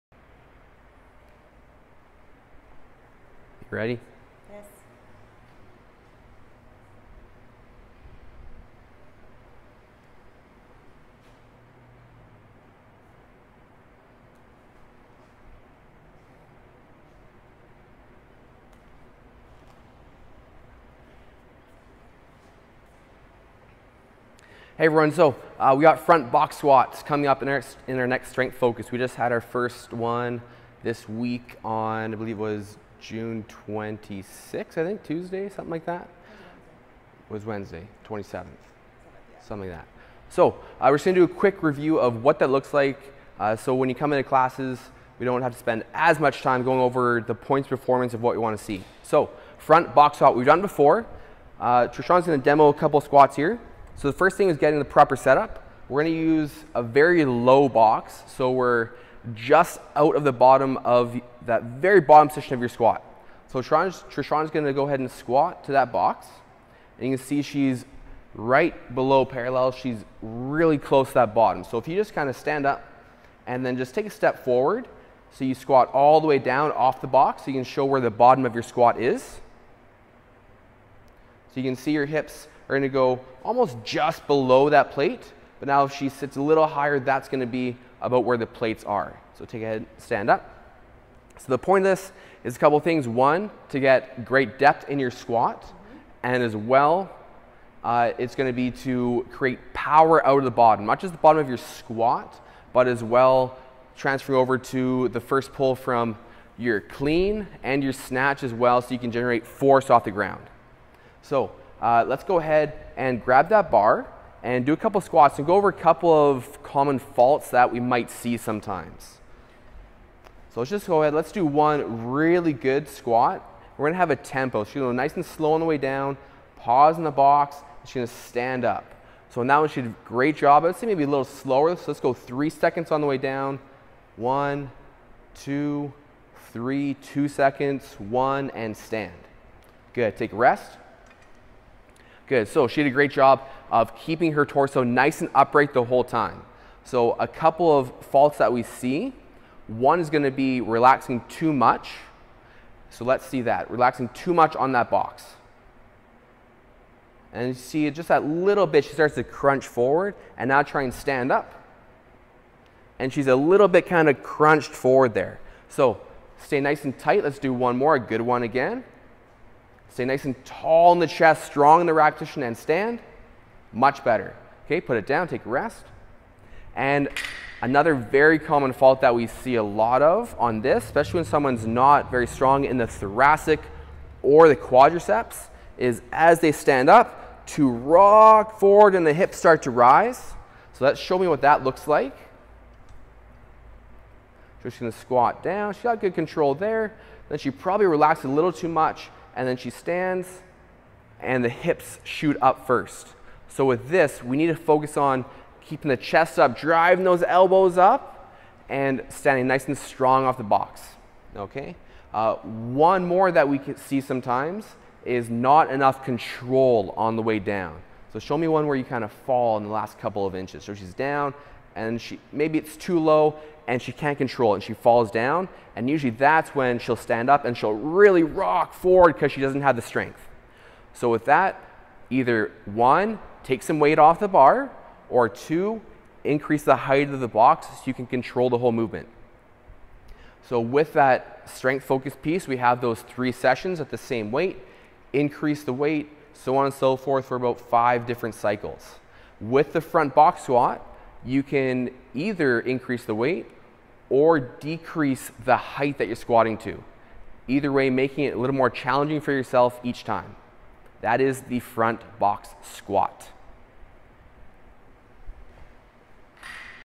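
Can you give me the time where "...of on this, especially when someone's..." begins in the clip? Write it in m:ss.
3:00.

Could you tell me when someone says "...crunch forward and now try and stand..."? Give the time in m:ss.
2:39.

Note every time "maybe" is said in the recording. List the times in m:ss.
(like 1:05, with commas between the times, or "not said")
2:10, 3:42.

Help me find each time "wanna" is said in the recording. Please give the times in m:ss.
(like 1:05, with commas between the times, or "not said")
0:48.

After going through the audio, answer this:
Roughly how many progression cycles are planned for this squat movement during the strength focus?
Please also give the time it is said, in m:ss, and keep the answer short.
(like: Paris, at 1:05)
5, at 4:07.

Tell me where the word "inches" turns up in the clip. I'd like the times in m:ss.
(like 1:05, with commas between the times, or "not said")
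3:40.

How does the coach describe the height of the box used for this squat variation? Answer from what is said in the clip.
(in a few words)
a very low box.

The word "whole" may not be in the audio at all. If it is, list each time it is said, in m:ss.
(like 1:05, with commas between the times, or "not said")
2:25, 3:58.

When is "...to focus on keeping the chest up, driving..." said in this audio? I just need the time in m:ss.
3:24.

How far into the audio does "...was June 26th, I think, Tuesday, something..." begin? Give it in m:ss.
0:32.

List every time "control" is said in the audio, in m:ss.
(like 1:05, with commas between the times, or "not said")
3:16, 3:36, 3:44, 3:58.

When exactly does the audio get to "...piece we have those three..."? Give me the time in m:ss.
4:02.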